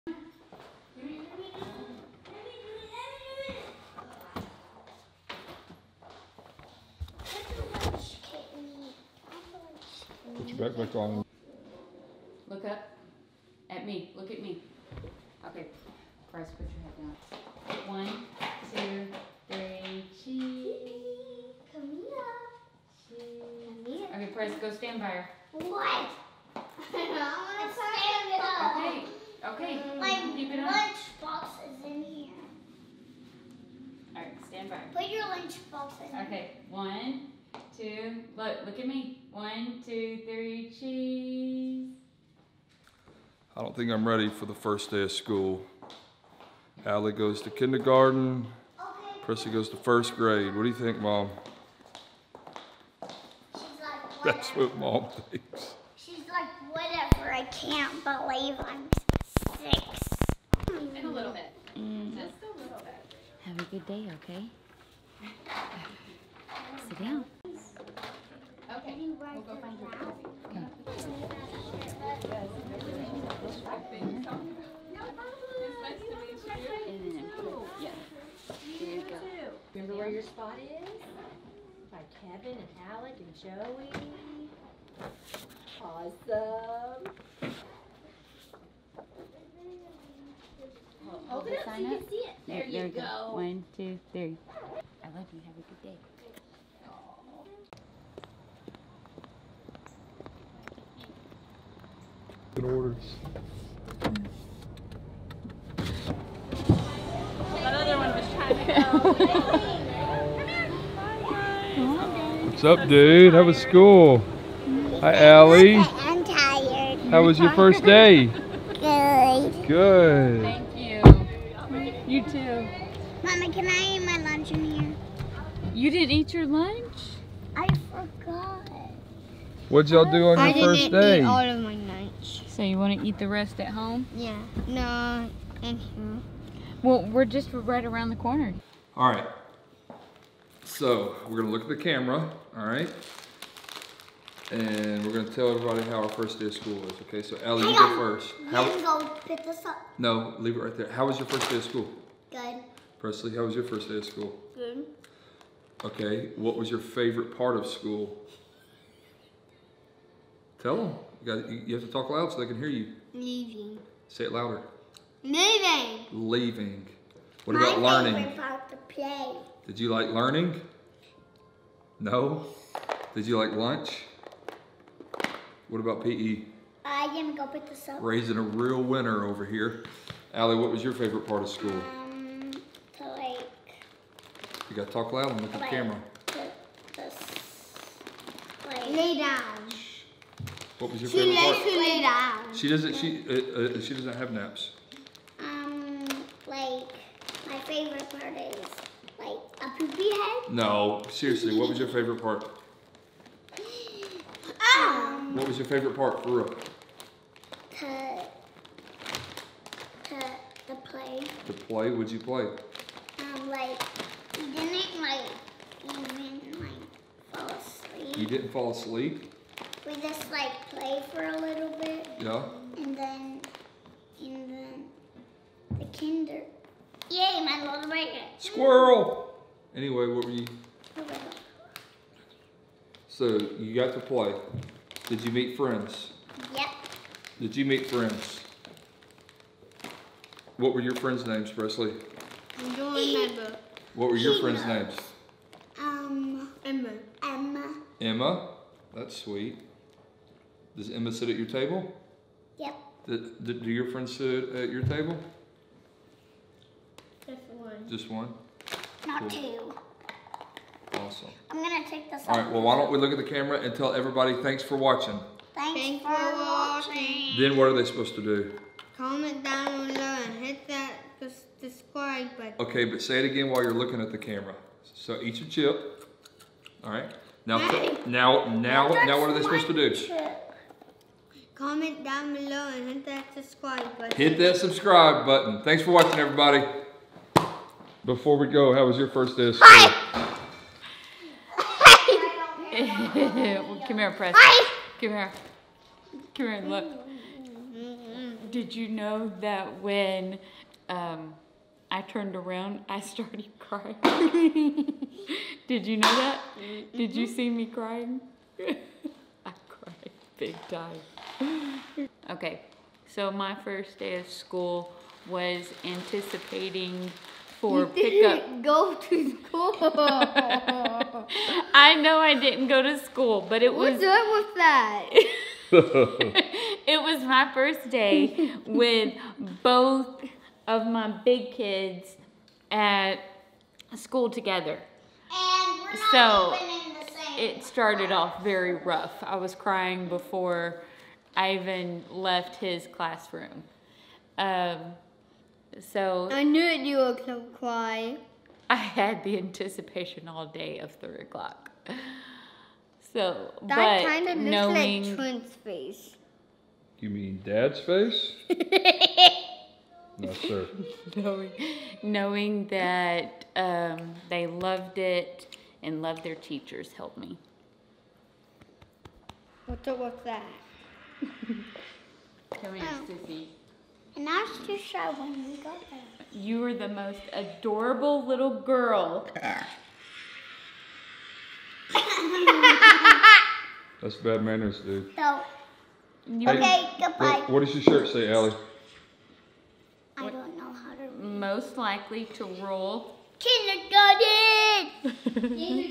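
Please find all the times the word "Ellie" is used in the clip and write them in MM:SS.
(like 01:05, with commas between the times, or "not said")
02:27.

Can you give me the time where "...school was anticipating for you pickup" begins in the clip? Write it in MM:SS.
05:14.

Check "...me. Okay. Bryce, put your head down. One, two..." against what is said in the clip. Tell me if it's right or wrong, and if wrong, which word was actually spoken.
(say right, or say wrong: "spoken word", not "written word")
right.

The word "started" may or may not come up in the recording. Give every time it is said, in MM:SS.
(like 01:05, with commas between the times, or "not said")
05:03, 05:37.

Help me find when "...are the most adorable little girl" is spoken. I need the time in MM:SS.
06:16.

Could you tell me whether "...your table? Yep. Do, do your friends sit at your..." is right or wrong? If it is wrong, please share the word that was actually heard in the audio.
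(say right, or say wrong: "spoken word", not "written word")
right.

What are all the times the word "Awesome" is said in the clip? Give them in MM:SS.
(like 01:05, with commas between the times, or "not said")
01:25, 04:20.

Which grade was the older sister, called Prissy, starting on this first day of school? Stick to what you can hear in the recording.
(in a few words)
First grade.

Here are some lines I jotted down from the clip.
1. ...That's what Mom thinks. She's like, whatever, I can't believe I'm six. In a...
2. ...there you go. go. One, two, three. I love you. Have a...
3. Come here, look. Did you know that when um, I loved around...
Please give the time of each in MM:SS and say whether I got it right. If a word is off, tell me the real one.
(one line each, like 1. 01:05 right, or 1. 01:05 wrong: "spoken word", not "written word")
1. 00:54 right
2. 01:32 right
3. 04:56 wrong: "turned", not "loved".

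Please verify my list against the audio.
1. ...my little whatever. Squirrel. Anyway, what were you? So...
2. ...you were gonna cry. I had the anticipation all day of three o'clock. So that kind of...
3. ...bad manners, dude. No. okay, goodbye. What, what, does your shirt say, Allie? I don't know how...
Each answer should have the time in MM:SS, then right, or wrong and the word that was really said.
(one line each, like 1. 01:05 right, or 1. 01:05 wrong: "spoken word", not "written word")
1. 03:47 wrong: "breaker", not "whatever"
2. 05:46 right
3. 06:24 right.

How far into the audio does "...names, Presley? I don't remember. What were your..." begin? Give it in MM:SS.
04:01.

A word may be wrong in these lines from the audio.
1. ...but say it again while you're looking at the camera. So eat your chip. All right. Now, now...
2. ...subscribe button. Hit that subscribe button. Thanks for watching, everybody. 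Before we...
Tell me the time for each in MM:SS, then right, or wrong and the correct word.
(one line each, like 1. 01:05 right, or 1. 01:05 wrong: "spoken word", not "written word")
1. 04:32 right
2. 04:43 right.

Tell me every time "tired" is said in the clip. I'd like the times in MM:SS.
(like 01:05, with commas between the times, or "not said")
01:56.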